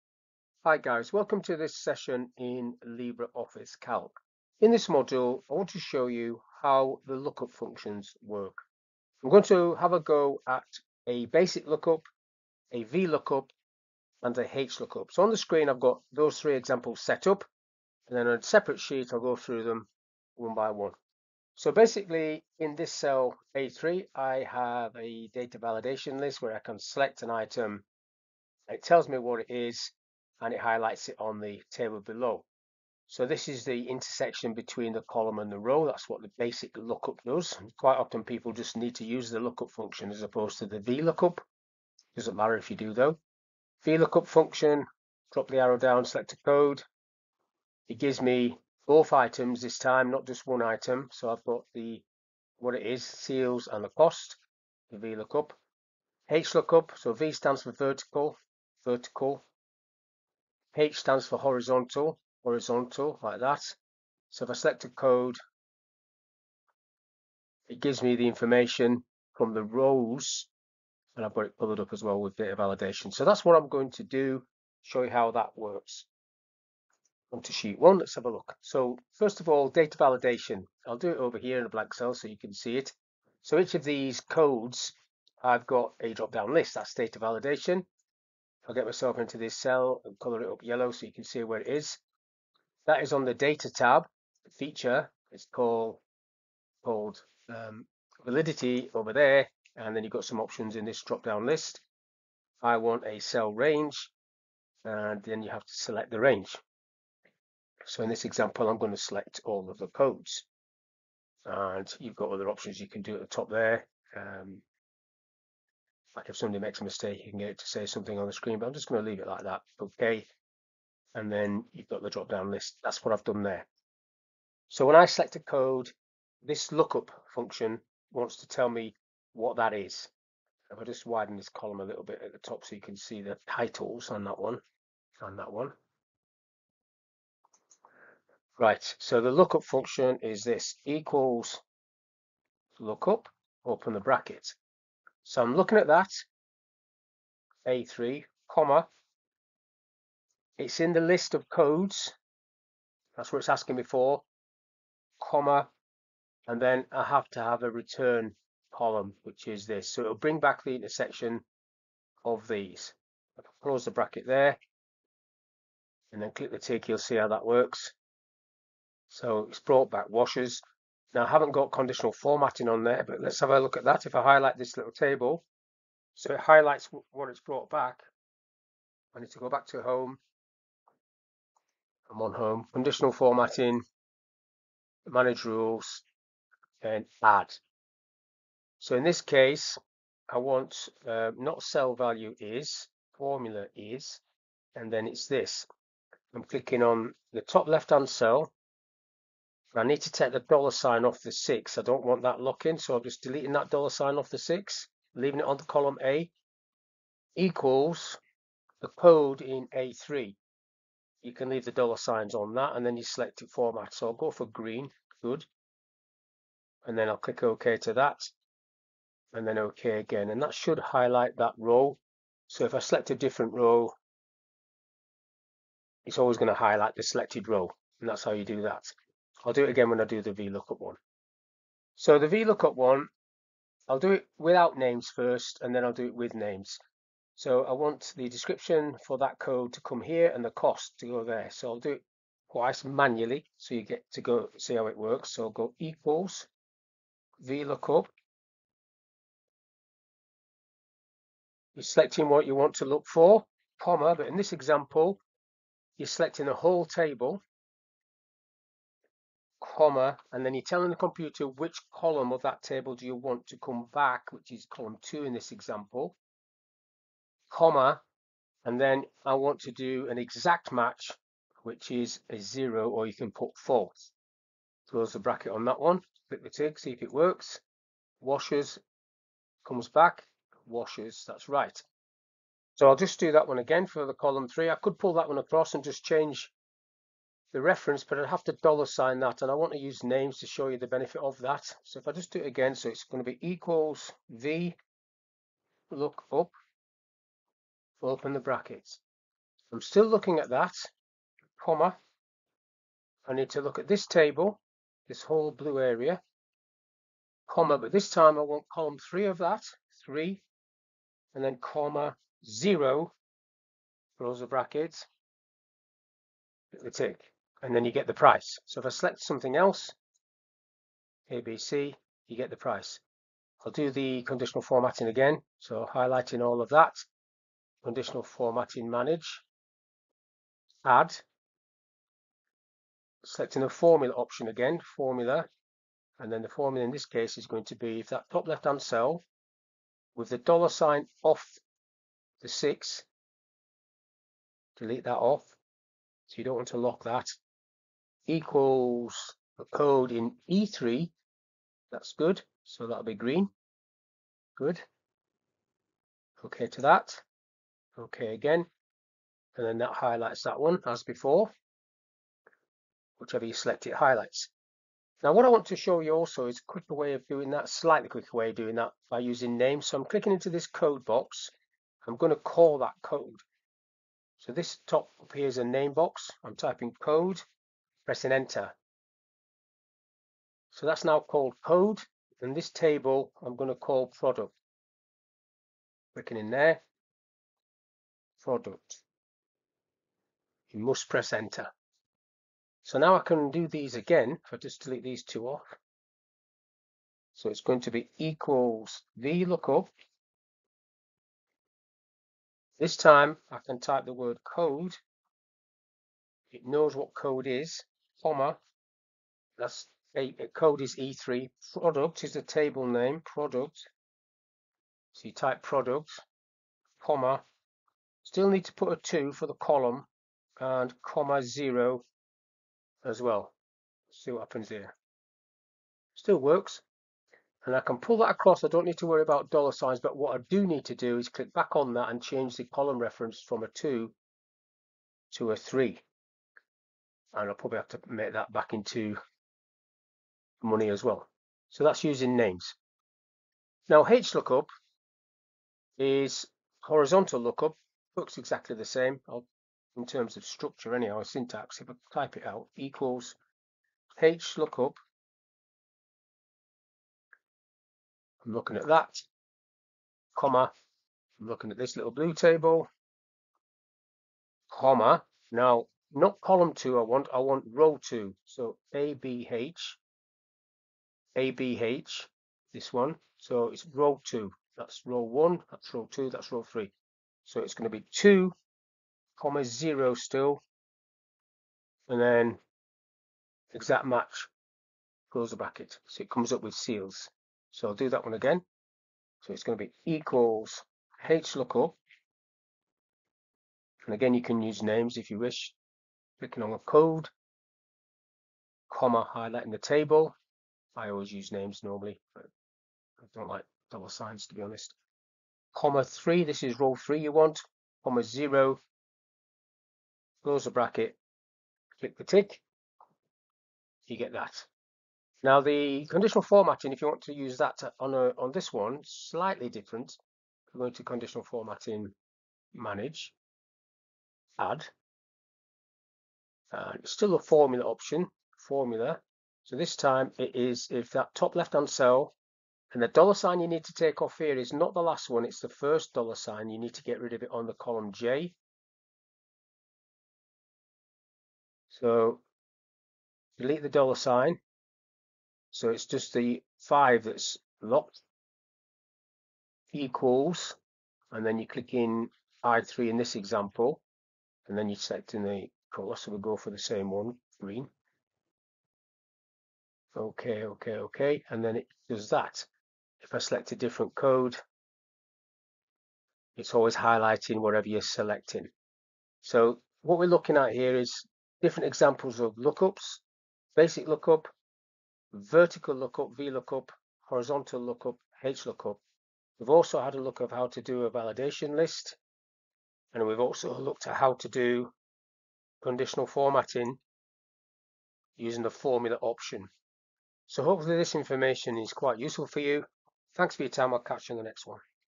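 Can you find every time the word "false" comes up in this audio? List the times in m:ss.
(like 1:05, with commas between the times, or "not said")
4:33.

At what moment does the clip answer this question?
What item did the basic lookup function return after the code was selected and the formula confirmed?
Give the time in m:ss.
2:50.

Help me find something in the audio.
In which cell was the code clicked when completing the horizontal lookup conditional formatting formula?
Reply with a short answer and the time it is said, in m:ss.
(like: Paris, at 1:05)
I3, at 9:12.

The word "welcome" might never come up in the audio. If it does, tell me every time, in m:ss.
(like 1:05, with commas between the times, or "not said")
0:01.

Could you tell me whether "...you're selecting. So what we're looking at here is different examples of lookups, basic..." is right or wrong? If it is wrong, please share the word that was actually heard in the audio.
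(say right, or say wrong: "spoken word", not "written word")
right.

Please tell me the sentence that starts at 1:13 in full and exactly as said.
So that's what I'm going to do, show you how that works.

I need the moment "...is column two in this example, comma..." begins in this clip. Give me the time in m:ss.
4:24.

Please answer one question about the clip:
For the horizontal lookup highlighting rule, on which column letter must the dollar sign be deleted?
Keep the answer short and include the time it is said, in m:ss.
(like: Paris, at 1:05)
J, at 8:57.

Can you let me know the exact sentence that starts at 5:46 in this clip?
So you don't want to lock that equals a code in E3.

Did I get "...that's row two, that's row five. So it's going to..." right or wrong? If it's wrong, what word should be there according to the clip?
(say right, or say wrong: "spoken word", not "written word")
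wrong: "three", not "five".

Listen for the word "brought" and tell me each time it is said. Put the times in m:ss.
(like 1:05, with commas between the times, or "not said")
2:49, 2:57.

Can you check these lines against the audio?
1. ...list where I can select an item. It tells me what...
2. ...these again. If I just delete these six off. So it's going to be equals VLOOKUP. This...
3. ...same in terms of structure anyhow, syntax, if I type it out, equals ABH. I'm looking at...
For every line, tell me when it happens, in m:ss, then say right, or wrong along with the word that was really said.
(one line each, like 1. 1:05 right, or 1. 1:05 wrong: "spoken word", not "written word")
1. 0:26 right
2. 6:33 wrong: "two", not "six"
3. 7:28 wrong: "HLOOKUP", not "ABH".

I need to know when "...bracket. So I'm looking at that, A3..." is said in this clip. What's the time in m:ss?
2:23.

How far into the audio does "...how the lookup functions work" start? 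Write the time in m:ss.
0:06.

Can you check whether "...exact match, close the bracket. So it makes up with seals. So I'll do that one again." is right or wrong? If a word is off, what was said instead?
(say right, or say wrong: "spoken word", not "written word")
wrong: "comes", not "makes".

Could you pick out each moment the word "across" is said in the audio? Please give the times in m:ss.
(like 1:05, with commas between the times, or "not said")
4:45, 7:08.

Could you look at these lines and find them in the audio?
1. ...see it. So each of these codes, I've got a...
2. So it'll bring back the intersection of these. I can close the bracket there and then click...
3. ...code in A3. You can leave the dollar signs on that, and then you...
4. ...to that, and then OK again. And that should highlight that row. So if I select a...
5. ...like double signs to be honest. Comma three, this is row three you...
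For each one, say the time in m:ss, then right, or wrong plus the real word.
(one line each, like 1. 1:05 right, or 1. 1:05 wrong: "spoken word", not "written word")
1. 1:22 right
2. 2:39 right
3. 3:28 right
4. 3:37 right
5. 8:23 right.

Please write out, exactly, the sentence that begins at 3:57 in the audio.
So I want the description for that code to come here and the cost to go there.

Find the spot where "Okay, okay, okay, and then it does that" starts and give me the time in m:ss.
9:20.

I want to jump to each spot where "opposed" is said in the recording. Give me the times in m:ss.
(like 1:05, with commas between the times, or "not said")
0:40.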